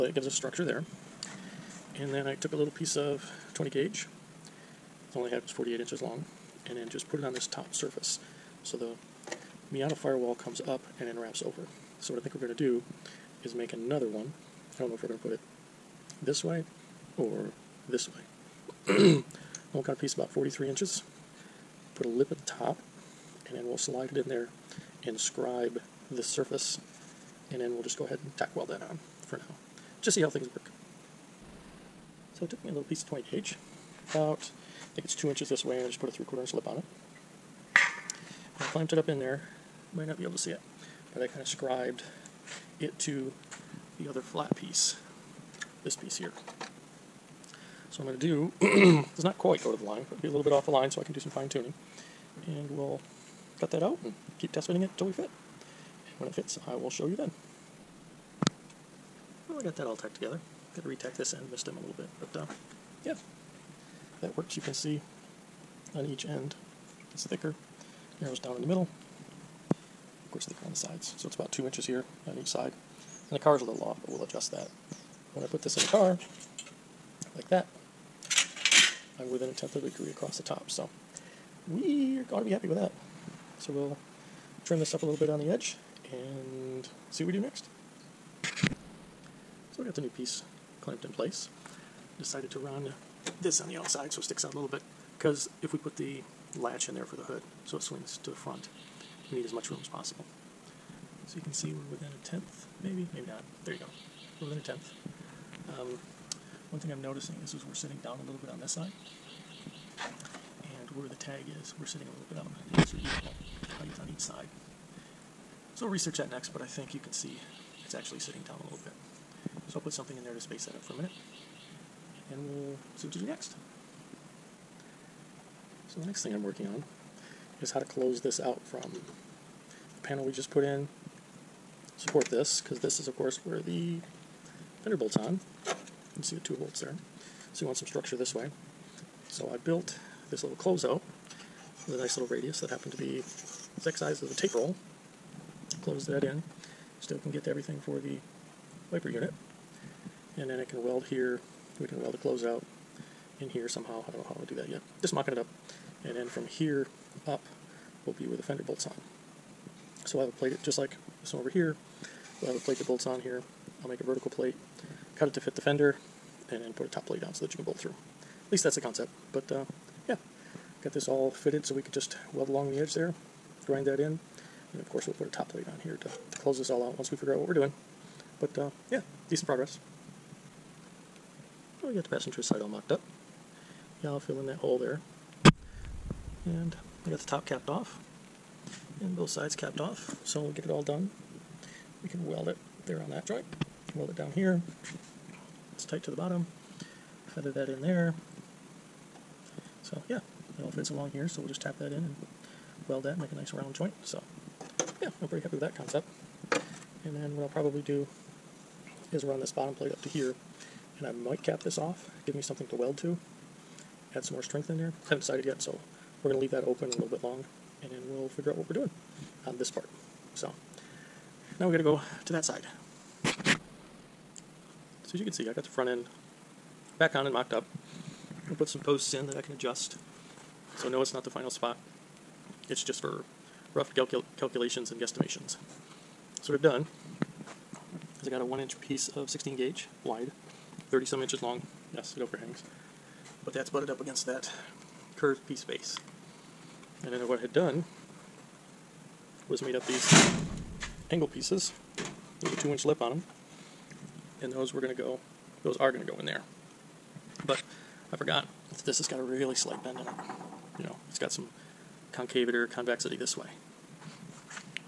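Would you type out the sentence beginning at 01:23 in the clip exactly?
So we'll trim this up a little bit on the edge and see what we do next.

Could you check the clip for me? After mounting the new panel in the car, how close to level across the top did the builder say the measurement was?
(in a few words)
a tenth of a degree.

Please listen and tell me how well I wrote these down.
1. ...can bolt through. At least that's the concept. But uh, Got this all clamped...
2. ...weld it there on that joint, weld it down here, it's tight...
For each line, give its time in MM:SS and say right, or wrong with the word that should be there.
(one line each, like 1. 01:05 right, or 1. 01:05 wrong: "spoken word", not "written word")
1. 02:47 wrong: "fitted", not "clamped"
2. 03:12 right.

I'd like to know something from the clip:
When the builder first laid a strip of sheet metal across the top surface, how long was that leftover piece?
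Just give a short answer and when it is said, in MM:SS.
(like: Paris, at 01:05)
48 inches, at 00:05.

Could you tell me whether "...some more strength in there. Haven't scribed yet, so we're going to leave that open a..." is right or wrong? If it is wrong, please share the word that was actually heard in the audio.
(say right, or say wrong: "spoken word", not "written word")
wrong: "decided", not "scribed".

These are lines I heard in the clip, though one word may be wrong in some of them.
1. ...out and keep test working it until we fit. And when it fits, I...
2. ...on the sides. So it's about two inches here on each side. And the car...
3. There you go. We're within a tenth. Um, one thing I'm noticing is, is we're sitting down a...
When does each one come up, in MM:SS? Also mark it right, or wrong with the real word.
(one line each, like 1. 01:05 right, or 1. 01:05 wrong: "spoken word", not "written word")
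1. 00:53 wrong: "fitting", not "working"
2. 01:10 right
3. 01:43 right.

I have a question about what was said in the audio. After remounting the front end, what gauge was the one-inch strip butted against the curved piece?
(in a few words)
16 gauge.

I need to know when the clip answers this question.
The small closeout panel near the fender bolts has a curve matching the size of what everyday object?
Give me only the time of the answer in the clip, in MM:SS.
02:24.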